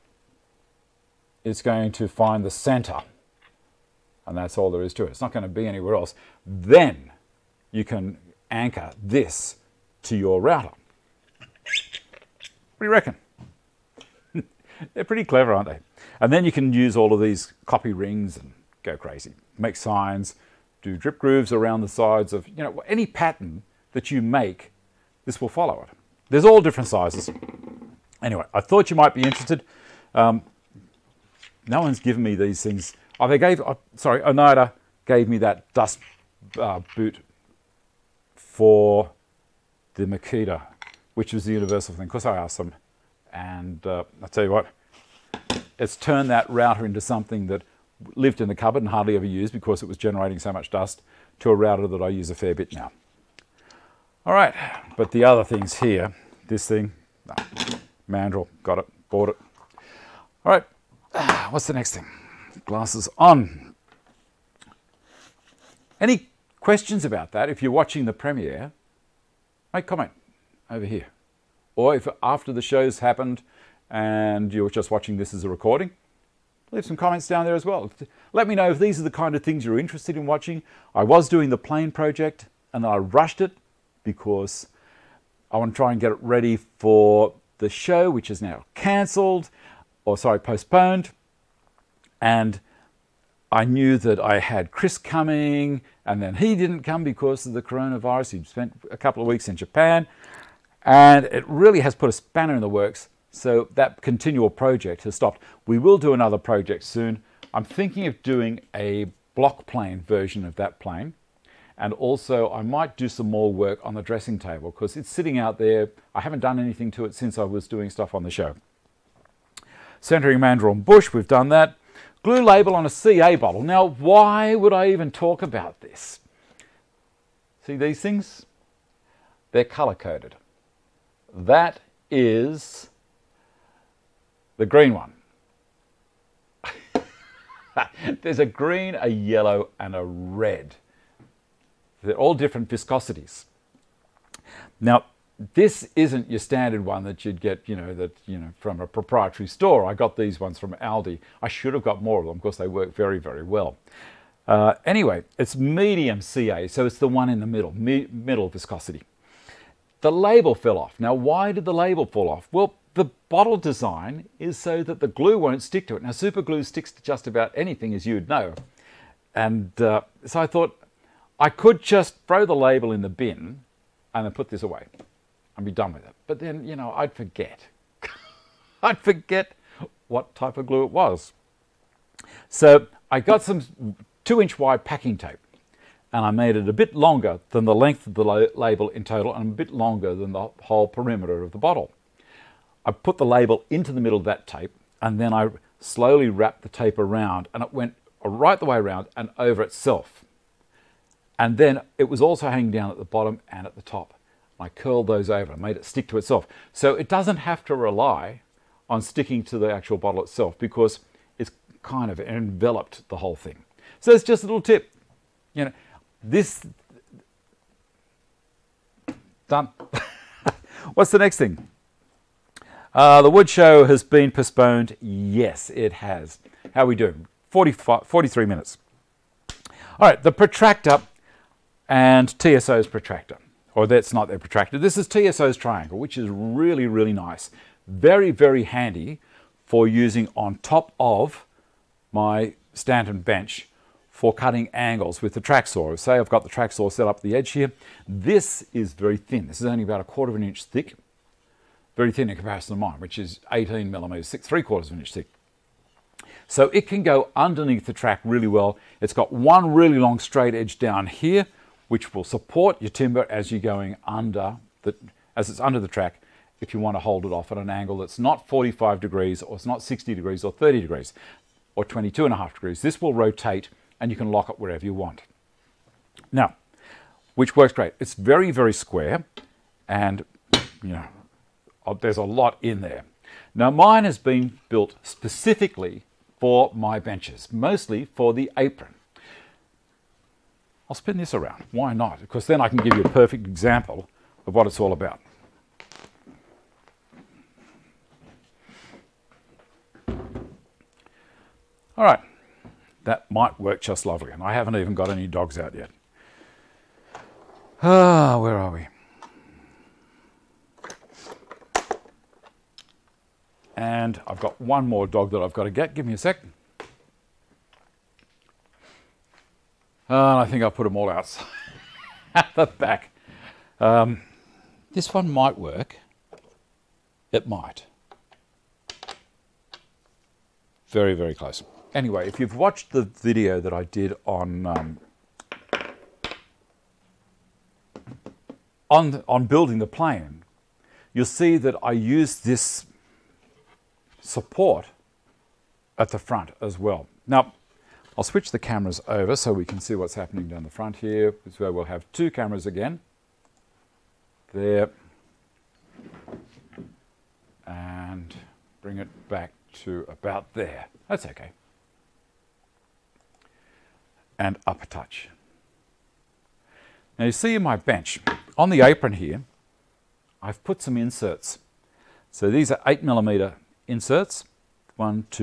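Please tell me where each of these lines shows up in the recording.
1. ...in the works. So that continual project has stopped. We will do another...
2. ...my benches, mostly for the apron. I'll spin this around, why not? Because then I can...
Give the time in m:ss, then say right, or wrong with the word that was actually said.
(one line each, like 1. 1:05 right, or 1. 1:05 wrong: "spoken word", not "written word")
1. 1:42 right
2. 4:46 right.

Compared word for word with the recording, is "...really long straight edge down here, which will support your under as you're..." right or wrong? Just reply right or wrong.
wrong.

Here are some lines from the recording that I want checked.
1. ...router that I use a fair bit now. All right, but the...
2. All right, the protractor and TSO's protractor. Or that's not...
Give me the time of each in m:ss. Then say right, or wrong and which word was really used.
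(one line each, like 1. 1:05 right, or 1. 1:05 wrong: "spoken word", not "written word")
1. 0:51 right
2. 3:50 right.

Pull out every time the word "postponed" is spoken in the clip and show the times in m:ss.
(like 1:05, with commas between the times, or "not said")
1:30, 3:44.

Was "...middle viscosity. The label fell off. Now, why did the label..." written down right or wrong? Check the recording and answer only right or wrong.
right.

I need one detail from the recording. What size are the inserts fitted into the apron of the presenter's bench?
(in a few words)
8 millimeter.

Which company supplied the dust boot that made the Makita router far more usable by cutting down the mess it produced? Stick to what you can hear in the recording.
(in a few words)
Oneida.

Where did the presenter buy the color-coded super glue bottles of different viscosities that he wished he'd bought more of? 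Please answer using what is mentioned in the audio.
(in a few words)
Aldi.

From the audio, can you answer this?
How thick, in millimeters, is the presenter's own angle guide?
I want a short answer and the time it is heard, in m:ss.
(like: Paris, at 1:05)
18 millimeters, at 4:13.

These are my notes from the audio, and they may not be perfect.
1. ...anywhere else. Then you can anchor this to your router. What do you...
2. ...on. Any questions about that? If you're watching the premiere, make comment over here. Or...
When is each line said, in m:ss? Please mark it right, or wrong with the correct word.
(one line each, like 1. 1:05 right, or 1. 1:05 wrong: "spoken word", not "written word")
1. 0:05 right
2. 1:03 right.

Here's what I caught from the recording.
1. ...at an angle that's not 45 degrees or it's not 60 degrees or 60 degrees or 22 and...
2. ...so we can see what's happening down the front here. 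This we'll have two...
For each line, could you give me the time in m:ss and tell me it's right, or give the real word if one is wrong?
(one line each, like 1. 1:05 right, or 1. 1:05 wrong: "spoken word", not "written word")
1. 4:27 wrong: "30", not "60"
2. 5:49 right.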